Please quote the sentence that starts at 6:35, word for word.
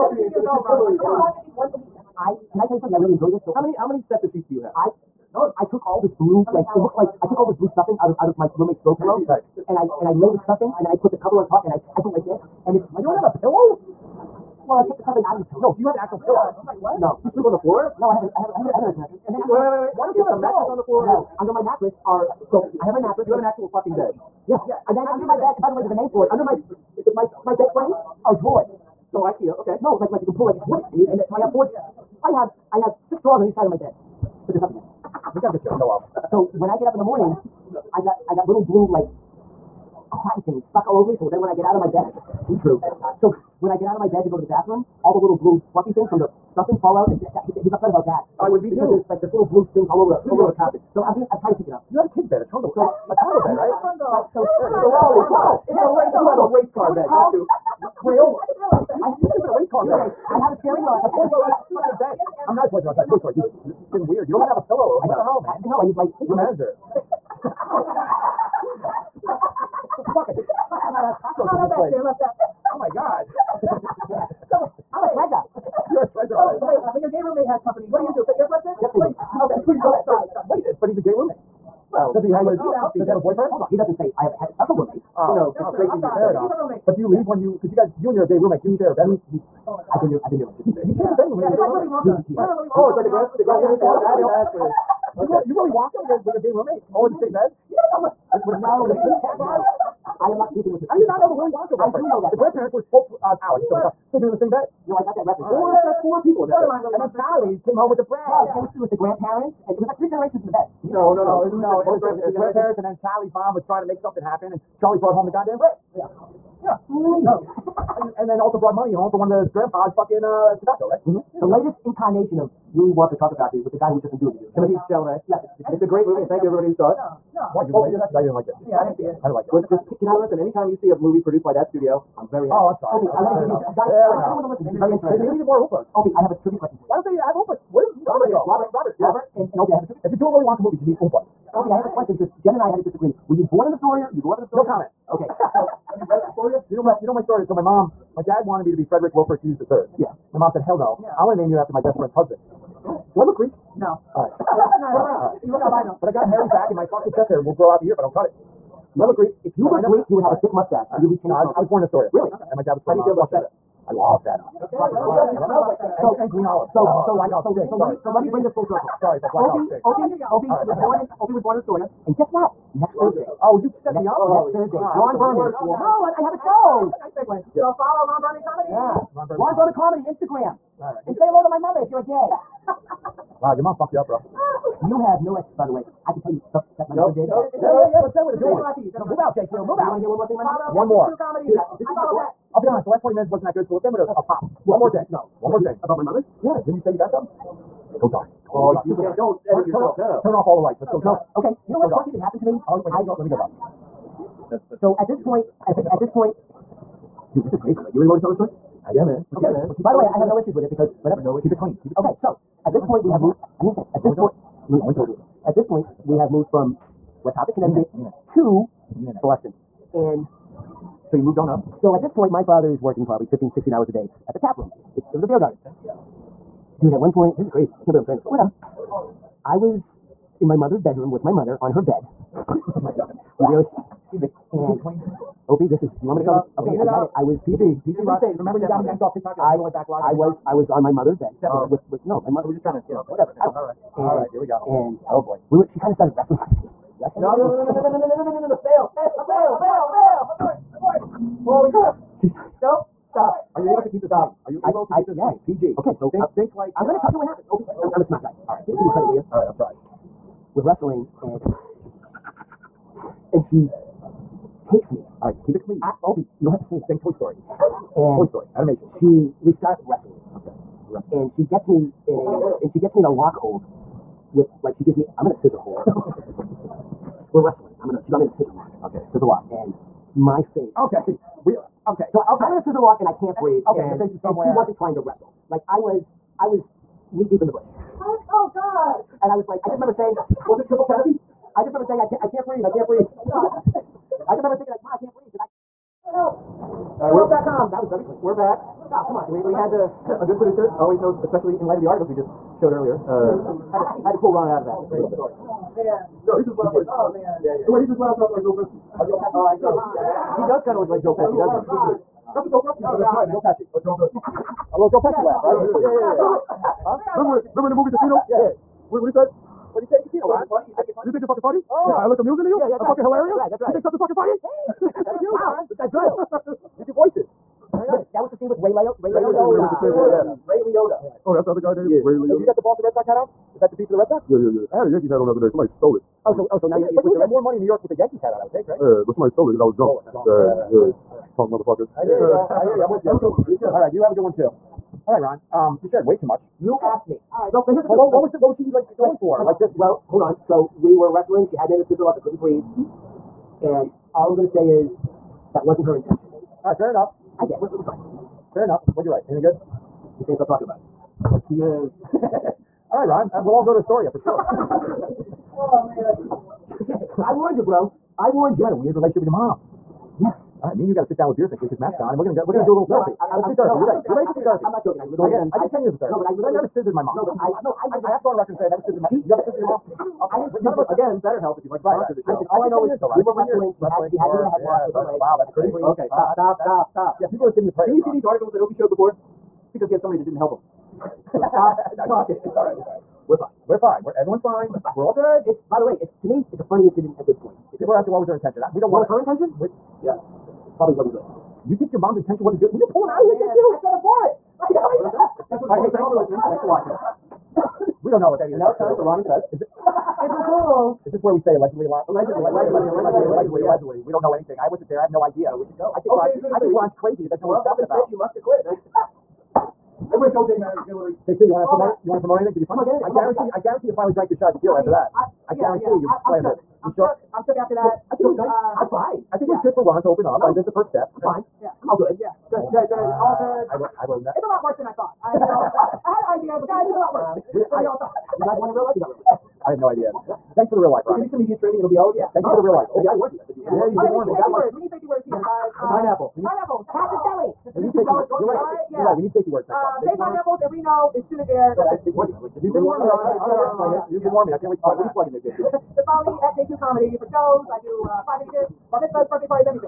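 It's by the way, it's to me, it's a funny incident at this point.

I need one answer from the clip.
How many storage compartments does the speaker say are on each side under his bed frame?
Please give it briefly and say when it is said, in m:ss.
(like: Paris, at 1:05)
6, at 0:33.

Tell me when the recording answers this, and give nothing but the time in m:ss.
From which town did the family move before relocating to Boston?
3:37.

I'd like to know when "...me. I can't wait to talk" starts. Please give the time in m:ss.
7:34.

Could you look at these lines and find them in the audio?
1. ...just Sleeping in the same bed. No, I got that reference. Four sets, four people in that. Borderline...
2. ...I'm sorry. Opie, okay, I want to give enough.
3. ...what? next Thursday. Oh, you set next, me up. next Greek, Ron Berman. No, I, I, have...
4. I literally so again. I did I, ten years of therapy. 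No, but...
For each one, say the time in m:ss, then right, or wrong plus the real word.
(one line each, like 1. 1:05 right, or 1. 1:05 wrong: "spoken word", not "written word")
1. 1:43 right
2. 2:12 right
3. 2:52 wrong: "Thursday", not "Greek"
4. 6:15 right.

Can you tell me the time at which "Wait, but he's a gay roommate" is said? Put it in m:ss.
1:20.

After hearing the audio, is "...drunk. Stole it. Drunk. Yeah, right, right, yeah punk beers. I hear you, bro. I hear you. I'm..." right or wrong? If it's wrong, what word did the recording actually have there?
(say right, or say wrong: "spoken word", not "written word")
wrong: "motherfuckers", not "beers".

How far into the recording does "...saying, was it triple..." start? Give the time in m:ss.
4:49.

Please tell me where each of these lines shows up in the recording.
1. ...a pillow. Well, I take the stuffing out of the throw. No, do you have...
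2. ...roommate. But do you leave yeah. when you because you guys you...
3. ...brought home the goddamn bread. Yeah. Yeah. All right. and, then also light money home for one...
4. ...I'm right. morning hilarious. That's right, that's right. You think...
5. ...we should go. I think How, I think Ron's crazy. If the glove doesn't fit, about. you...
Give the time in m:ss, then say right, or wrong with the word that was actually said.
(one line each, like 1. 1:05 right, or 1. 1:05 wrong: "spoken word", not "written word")
1. 0:13 wrong: "pillow", not "throw"
2. 1:26 right
3. 1:54 wrong: "brought", not "light"
4. 5:22 wrong: "fucking", not "morning"
5. 6:55 wrong: "Ron", not "How".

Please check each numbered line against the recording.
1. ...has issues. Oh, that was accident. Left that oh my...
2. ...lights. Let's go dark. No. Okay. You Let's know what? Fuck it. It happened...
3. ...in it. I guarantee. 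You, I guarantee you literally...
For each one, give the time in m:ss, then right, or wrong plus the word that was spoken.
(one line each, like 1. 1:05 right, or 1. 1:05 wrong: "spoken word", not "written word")
1. 1:11 wrong: "cockroaches", not "issues"
2. 3:20 right
3. 7:02 wrong: "finally", not "literally".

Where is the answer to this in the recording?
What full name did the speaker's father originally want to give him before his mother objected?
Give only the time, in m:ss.
2:28.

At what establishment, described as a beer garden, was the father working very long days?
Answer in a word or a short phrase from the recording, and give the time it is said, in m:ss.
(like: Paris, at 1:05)
The Tap Room, at 3:44.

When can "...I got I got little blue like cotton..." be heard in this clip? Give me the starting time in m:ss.
0:37.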